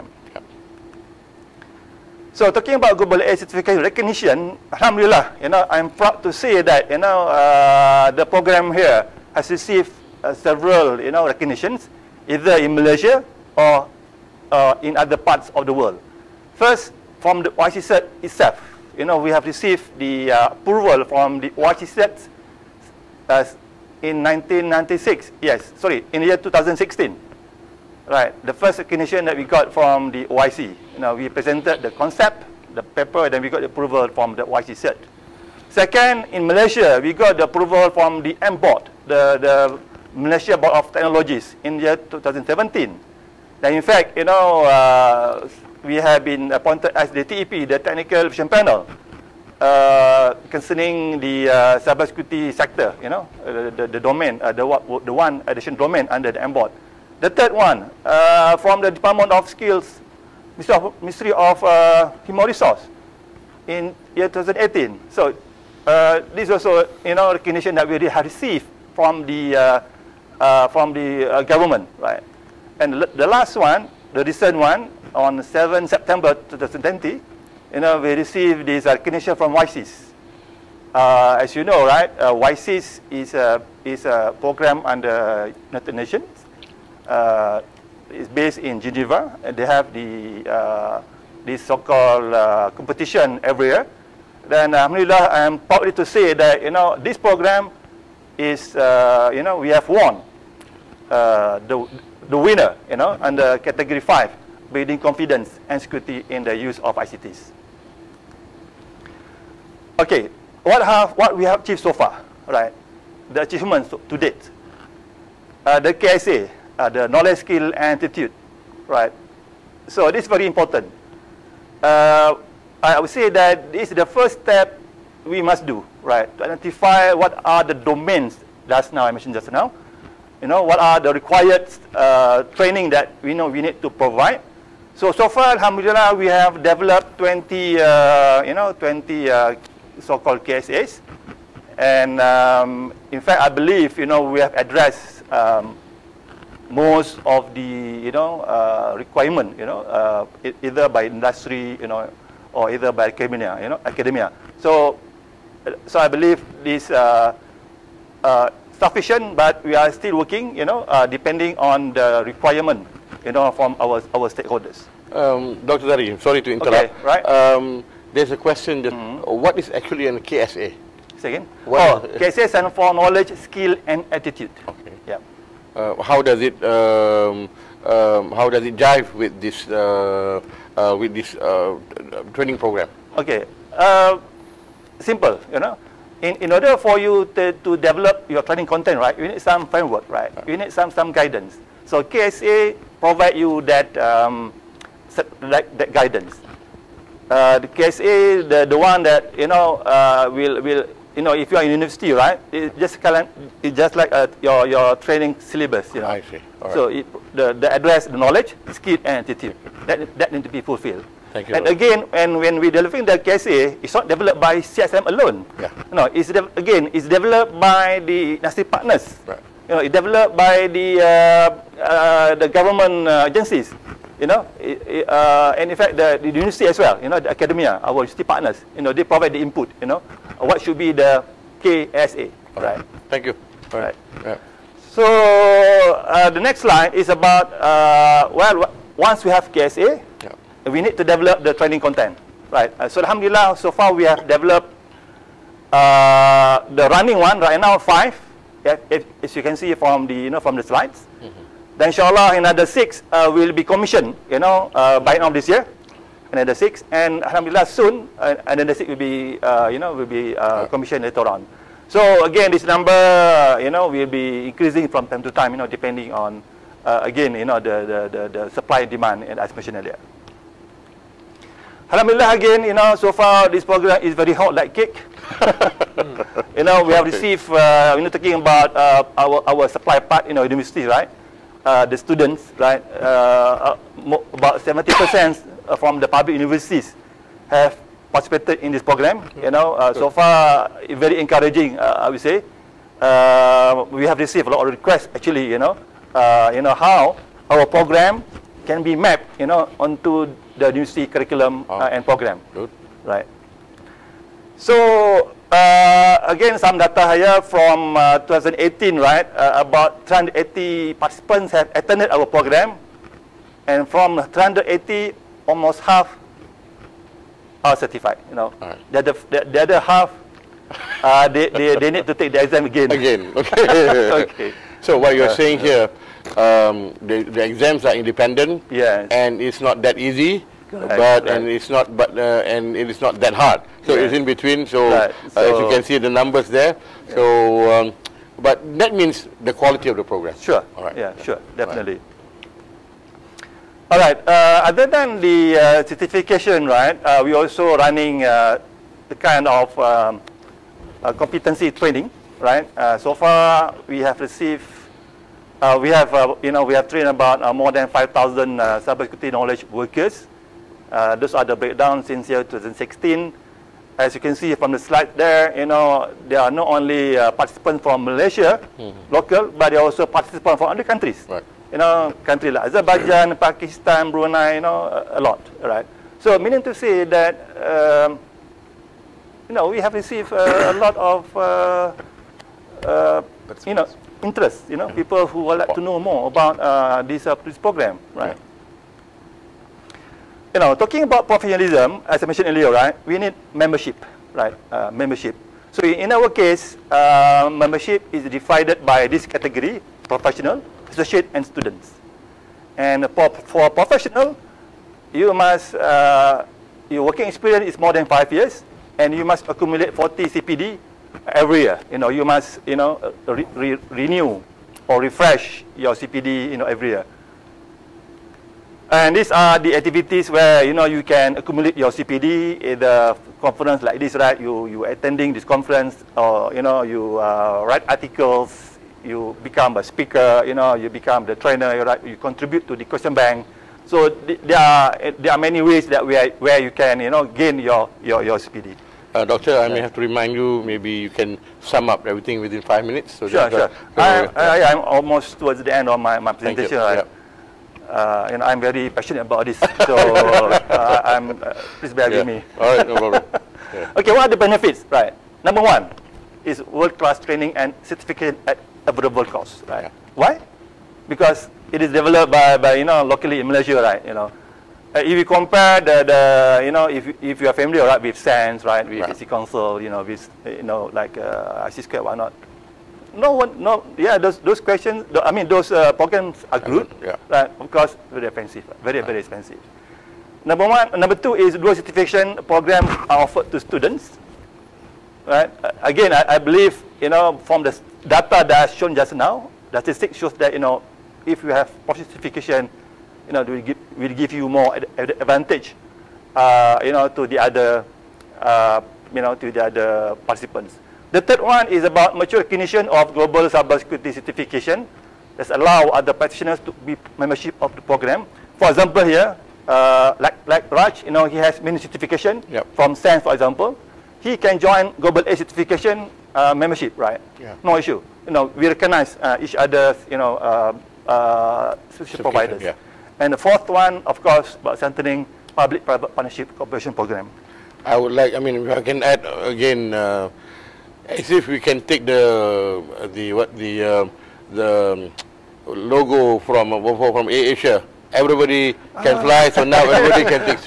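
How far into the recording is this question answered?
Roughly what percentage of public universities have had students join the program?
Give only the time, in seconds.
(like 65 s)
284 s.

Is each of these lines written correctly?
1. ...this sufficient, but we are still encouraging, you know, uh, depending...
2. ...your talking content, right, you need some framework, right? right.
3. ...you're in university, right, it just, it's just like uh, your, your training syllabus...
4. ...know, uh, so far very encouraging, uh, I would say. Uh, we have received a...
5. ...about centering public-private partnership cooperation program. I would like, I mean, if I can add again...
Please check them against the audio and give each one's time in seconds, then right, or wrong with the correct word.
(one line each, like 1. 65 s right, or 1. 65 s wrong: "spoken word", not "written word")
1. 156 s wrong: "working", not "encouraging"
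2. 188 s wrong: "training", not "talking"
3. 201 s right
4. 289 s right
5. 524 s right.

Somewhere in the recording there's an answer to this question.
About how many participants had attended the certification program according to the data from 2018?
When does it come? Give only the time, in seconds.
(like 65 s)
310 s.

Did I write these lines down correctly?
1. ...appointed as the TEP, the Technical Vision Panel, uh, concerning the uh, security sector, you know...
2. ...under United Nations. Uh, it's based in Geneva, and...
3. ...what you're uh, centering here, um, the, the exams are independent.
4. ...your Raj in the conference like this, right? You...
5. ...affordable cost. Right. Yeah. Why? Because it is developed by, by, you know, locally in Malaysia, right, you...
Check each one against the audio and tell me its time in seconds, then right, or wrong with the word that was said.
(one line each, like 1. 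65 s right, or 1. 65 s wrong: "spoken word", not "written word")
1. 46 s wrong: "cybersecurity", not "security"
2. 84 s right
3. 324 s wrong: "saying", not "centering"
4. 421 s wrong: "CPD", not "Raj"
5. 458 s right.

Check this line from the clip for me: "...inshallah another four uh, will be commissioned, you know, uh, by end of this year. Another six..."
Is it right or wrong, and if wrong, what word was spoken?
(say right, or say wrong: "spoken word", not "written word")
wrong: "six", not "four".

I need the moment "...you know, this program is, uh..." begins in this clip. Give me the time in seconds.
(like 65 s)
96 s.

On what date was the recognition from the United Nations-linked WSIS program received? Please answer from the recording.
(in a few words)
7 September 2020.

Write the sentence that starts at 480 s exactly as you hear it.
Number one, number two is dual certification programs are offered to students, right?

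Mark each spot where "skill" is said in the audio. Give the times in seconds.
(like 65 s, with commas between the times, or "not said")
59 s, 117 s, 173 s, 208 s.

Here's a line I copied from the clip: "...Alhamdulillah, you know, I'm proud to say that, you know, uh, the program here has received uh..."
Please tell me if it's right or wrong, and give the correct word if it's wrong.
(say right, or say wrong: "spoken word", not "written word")
right.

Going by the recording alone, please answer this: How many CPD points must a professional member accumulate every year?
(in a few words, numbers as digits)
40.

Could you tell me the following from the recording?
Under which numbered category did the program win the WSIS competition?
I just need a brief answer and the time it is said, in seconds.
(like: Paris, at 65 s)
5, at 103 s.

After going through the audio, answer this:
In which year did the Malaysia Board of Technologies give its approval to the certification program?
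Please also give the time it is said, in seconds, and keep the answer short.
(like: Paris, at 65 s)
2017, at 41 s.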